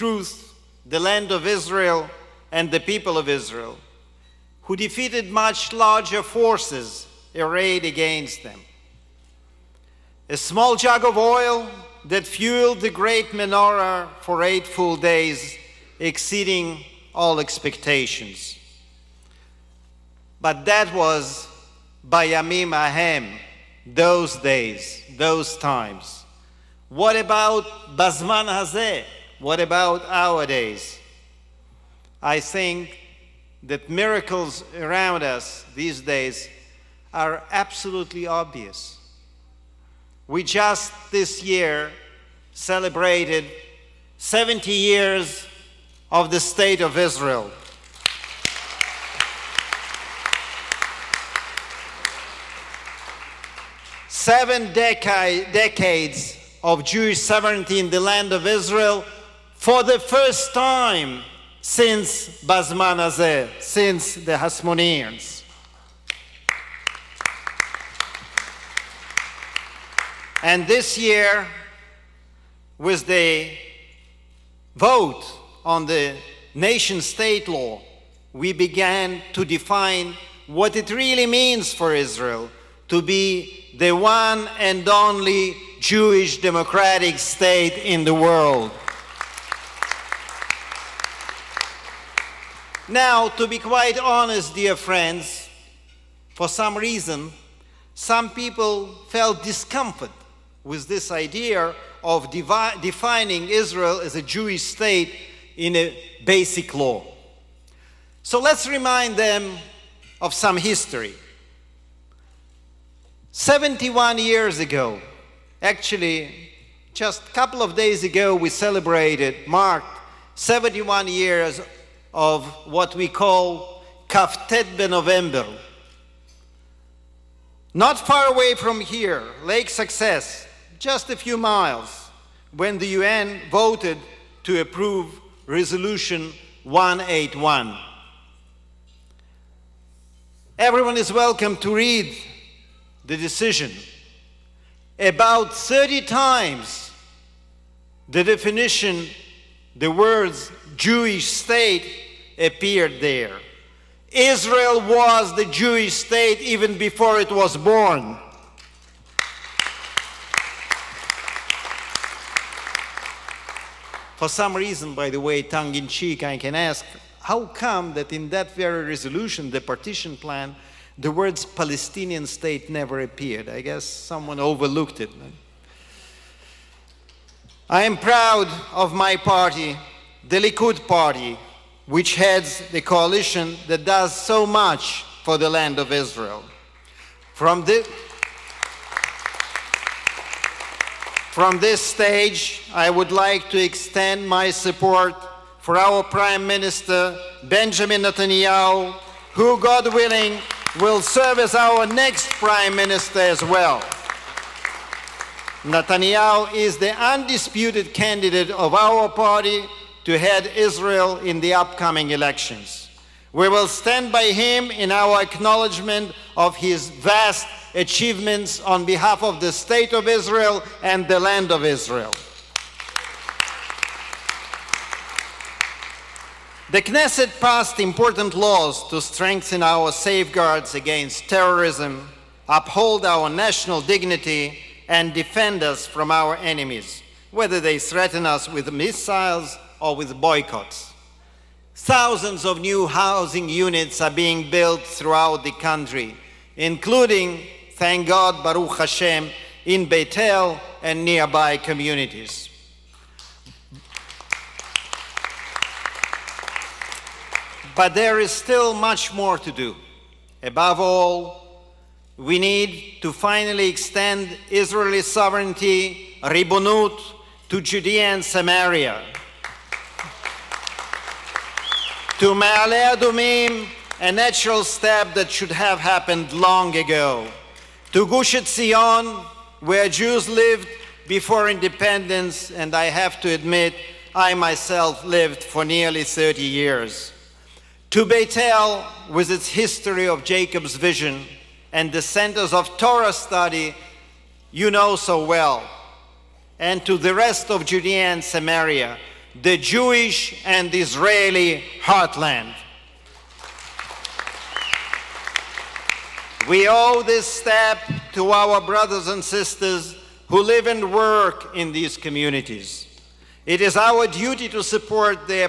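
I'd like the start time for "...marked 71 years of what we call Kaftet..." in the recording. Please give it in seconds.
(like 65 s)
119 s.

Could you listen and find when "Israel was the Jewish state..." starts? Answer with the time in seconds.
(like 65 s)
154 s.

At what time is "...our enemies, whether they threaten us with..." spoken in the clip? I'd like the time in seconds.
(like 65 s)
236 s.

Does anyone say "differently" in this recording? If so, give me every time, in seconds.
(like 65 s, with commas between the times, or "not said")
not said.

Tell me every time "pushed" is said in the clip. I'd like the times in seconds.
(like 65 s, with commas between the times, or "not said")
not said.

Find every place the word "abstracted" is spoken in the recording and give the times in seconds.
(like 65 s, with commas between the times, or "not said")
not said.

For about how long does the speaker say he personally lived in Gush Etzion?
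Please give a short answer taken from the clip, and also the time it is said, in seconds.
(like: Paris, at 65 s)
nearly 30 years, at 285 s.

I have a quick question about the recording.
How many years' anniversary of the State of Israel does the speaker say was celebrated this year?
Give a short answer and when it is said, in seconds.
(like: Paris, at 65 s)
70, at 44 s.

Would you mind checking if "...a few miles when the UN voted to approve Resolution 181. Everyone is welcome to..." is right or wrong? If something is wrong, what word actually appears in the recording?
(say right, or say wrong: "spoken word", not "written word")
right.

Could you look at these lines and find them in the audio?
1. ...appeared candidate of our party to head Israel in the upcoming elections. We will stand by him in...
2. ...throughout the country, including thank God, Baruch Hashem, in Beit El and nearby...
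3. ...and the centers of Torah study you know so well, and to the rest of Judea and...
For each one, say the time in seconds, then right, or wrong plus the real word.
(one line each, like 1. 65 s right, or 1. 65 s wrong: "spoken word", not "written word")
1. 206 s wrong: "undisputed", not "appeared"
2. 244 s right
3. 291 s right.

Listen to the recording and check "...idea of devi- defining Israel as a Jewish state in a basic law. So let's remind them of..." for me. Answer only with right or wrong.
right.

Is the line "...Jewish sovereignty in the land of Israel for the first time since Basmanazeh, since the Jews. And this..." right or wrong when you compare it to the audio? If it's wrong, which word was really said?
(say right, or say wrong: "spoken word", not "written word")
wrong: "Hasmoneans", not "Jews".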